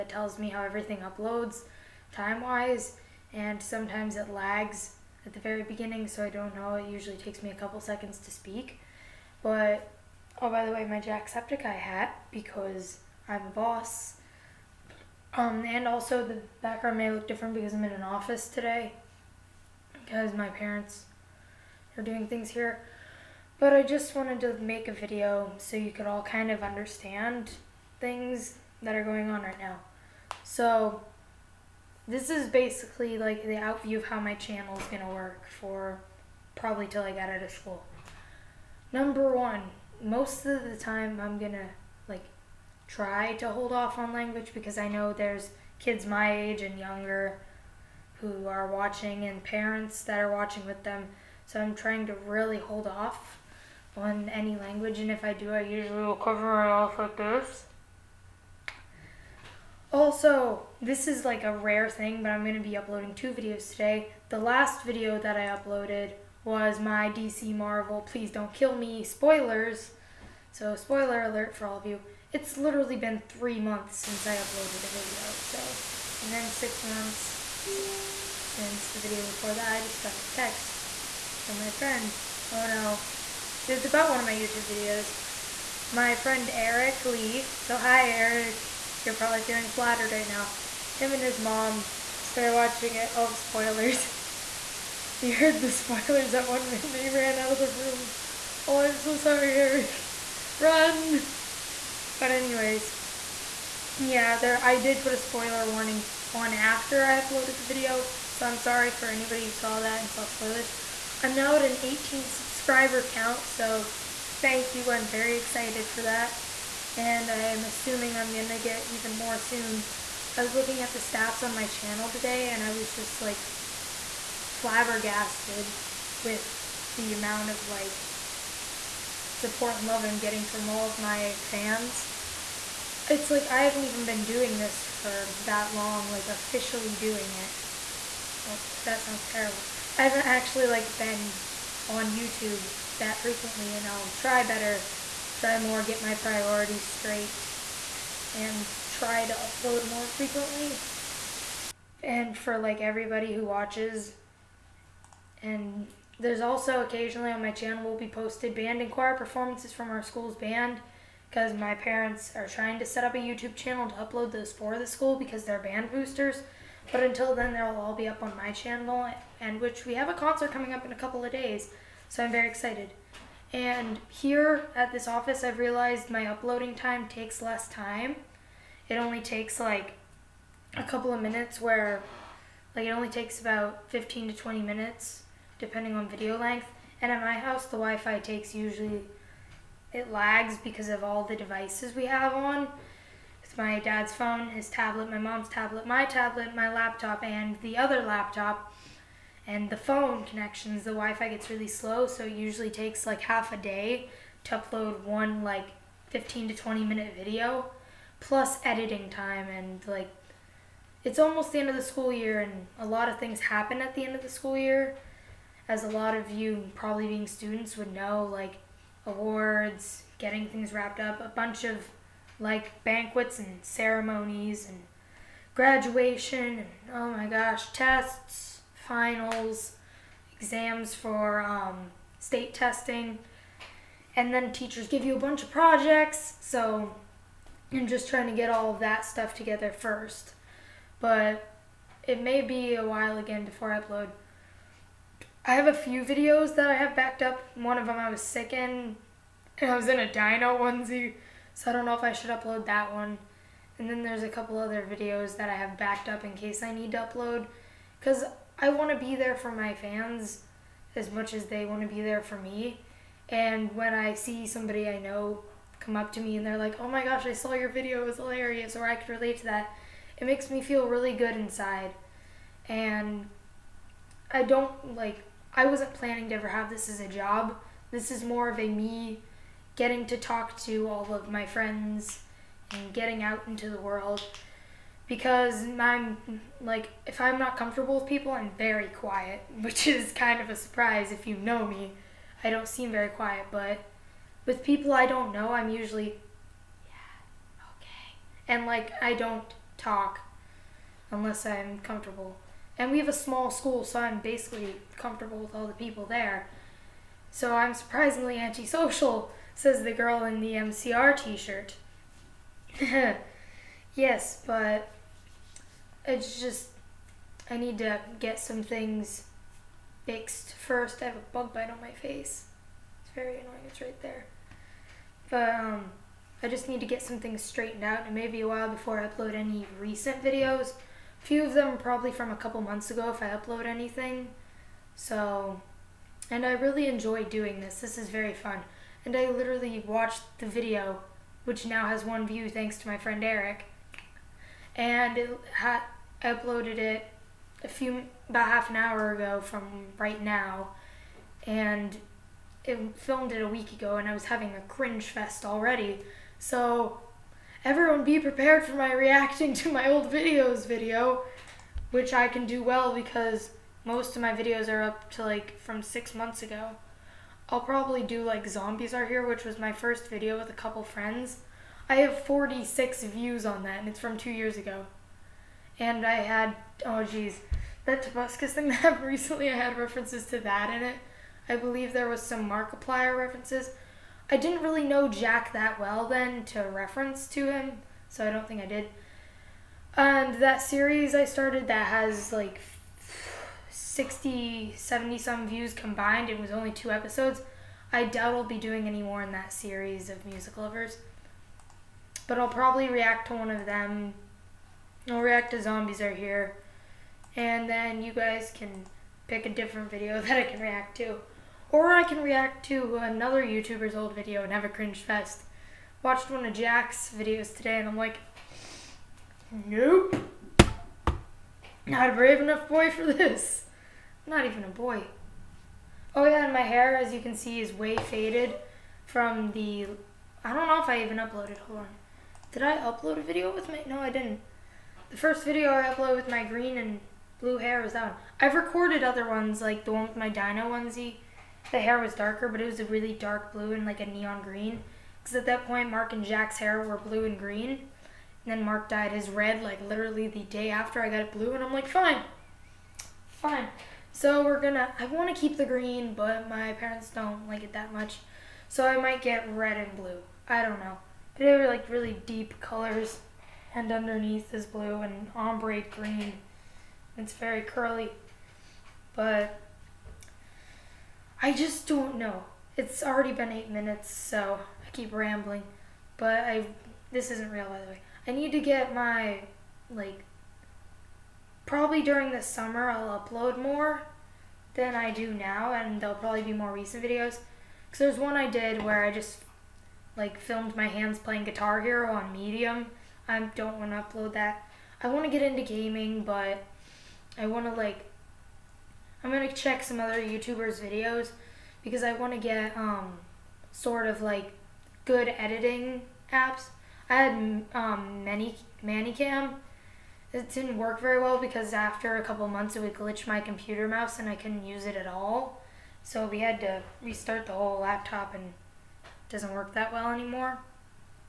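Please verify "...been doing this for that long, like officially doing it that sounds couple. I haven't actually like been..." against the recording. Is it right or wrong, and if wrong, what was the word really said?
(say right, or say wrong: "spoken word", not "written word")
wrong: "terrible", not "couple".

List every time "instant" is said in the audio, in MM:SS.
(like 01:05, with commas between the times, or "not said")
not said.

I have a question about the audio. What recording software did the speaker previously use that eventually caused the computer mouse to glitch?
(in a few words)
ManyCam.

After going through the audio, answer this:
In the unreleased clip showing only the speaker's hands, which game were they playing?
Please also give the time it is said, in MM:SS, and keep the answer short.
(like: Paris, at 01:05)
Guitar Hero, at 08:11.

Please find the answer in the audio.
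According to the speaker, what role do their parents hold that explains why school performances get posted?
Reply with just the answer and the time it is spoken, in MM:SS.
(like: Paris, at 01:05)
band boosters, at 02:45.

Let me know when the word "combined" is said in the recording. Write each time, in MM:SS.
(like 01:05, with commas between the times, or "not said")
06:35.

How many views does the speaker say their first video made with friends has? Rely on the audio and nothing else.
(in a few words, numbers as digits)
46.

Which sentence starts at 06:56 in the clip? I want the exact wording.
Watched one of Jack's videos today and I'm like, nope.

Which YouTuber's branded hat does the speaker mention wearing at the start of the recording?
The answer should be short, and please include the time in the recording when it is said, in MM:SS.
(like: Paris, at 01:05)
Jacksepticeye, at 00:11.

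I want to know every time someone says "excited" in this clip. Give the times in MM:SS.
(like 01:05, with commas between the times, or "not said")
01:55, 02:52.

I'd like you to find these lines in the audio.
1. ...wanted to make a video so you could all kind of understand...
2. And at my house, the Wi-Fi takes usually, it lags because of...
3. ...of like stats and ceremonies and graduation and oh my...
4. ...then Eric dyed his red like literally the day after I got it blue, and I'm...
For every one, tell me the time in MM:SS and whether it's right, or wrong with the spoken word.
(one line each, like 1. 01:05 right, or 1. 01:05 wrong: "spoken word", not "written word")
1. 00:24 right
2. 03:07 right
3. 03:41 wrong: "banquets", not "stats"
4. 07:28 wrong: "Mark", not "Eric".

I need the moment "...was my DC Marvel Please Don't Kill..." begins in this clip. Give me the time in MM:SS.
01:06.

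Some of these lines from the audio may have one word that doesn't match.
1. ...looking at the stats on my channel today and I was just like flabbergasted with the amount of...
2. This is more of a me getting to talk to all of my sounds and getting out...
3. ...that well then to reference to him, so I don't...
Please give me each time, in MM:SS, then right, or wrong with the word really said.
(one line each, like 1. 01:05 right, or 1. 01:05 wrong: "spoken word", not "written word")
1. 02:00 right
2. 04:37 wrong: "friends", not "sounds"
3. 06:25 right.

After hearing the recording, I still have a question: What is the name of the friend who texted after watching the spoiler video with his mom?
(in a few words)
Eric Lee.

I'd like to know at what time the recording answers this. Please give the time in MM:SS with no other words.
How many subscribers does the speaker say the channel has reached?
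01:51.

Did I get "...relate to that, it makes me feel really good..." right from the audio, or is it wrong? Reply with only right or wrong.
right.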